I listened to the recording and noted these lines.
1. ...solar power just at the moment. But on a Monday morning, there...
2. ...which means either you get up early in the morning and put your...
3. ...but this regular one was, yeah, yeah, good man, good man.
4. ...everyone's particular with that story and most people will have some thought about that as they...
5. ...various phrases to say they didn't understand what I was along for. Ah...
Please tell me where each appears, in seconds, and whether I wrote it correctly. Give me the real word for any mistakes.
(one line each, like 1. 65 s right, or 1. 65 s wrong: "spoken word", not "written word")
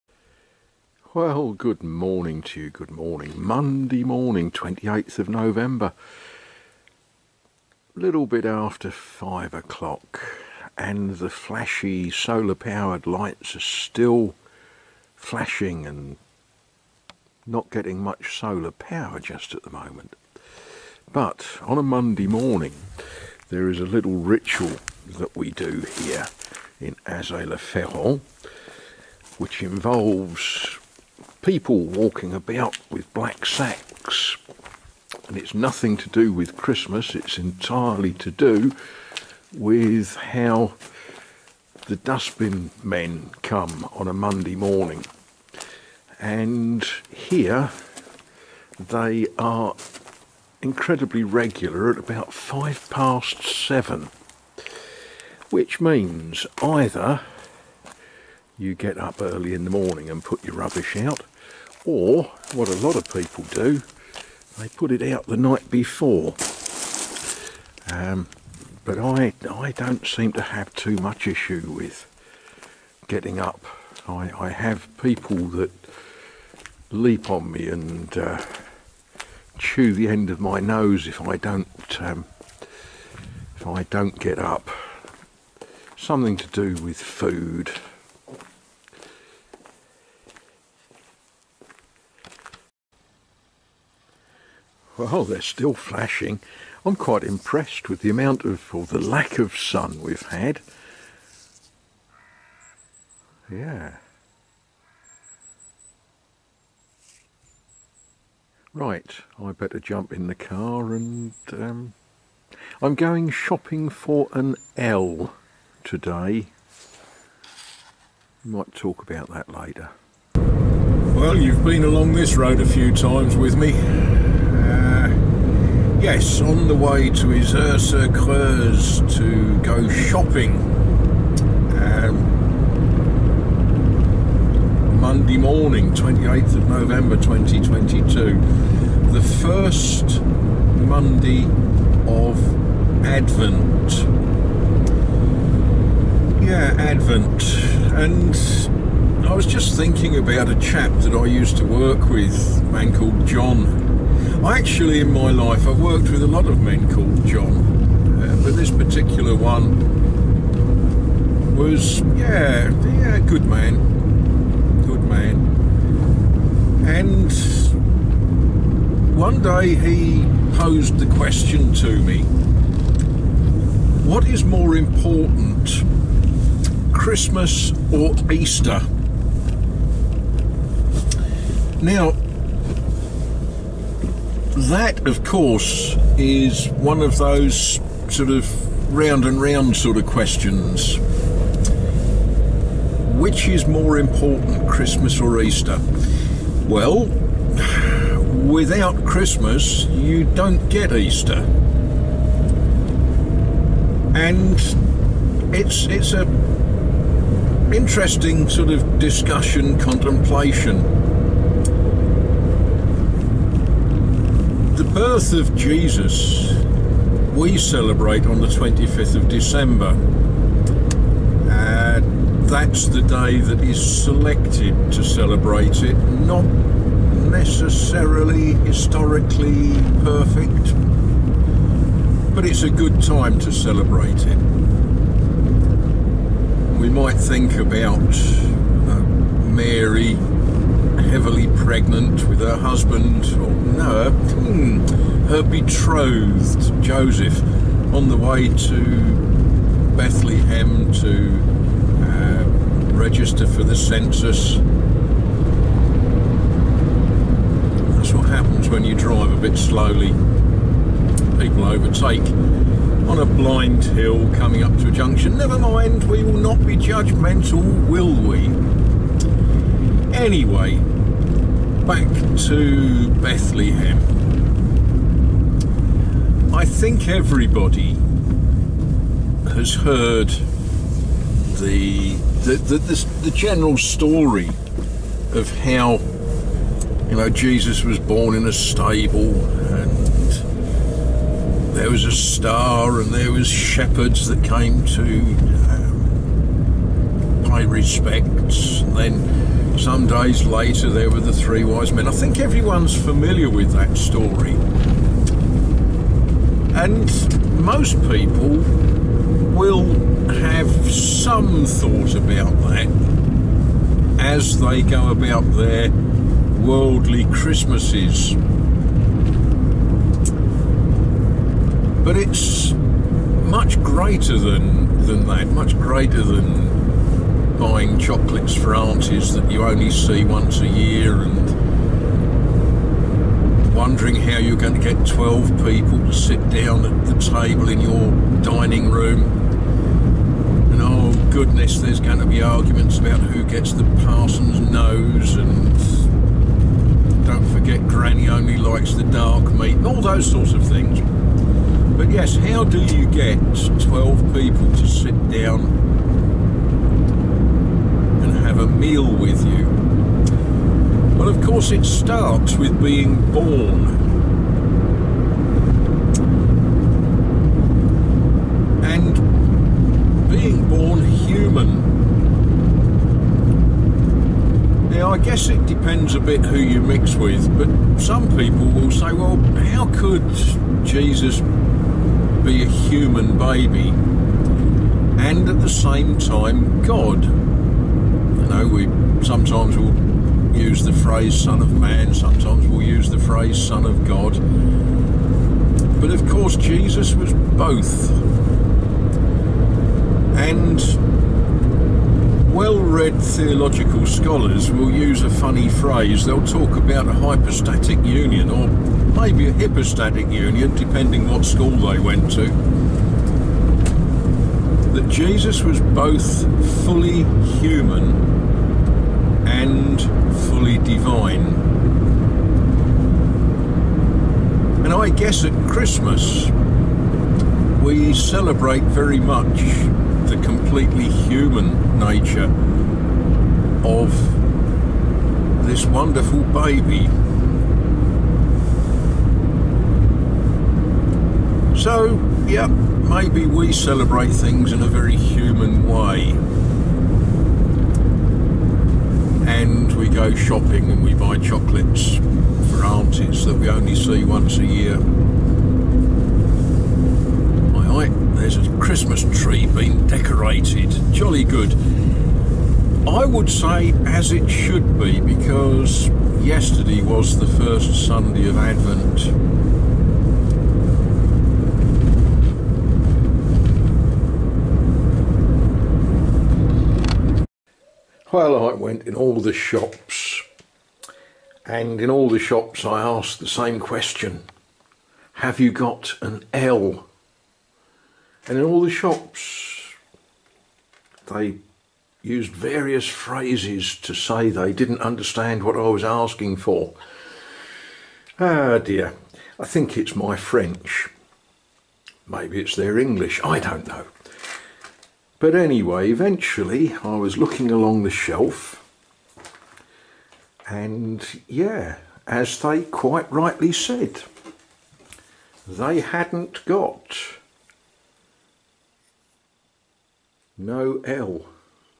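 1. 18 s right
2. 55 s right
3. 158 s wrong: "particular", not "regular"
4. 302 s wrong: "familiar", not "particular"
5. 492 s wrong: "asking", not "along".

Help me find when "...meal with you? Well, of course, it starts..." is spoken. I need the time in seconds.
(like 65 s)
358 s.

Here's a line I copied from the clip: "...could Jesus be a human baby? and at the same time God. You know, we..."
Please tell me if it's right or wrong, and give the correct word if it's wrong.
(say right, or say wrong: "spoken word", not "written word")
right.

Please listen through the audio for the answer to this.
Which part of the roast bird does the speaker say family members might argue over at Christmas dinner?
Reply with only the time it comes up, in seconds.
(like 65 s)
344 s.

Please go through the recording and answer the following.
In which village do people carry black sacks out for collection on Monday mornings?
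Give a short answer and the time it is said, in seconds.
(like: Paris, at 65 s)
Azay le Ferron, at 27 s.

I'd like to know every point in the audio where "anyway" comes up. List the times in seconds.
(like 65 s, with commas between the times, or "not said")
270 s, 505 s.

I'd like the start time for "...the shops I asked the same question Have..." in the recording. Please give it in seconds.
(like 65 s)
482 s.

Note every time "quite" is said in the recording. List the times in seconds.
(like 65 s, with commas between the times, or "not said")
96 s, 512 s.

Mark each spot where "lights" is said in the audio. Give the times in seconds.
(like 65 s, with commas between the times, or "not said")
13 s.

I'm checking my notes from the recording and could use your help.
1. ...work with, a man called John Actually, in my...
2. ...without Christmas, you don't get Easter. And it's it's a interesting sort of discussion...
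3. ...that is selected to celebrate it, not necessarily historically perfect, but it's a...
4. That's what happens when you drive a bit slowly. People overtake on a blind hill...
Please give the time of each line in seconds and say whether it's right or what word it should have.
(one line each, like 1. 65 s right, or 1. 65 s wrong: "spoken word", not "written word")
1. 151 s right
2. 198 s right
3. 223 s right
4. 257 s right.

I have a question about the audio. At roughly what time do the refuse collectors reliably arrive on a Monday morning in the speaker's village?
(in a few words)
7:05.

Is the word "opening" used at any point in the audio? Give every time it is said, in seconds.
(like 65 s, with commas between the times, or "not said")
not said.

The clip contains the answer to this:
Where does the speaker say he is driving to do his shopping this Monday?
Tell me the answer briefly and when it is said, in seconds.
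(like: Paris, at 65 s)
Creuse, at 127 s.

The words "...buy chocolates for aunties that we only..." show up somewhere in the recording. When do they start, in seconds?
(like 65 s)
451 s.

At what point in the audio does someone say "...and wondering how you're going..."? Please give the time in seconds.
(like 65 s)
331 s.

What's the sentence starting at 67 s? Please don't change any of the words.
Um, but I, I don't seem to have too much issue with getting up.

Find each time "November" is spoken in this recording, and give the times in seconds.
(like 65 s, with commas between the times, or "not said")
5 s, 136 s.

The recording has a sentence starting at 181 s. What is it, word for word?
Now, that, of course, is one of those sort of round and round sort of questions.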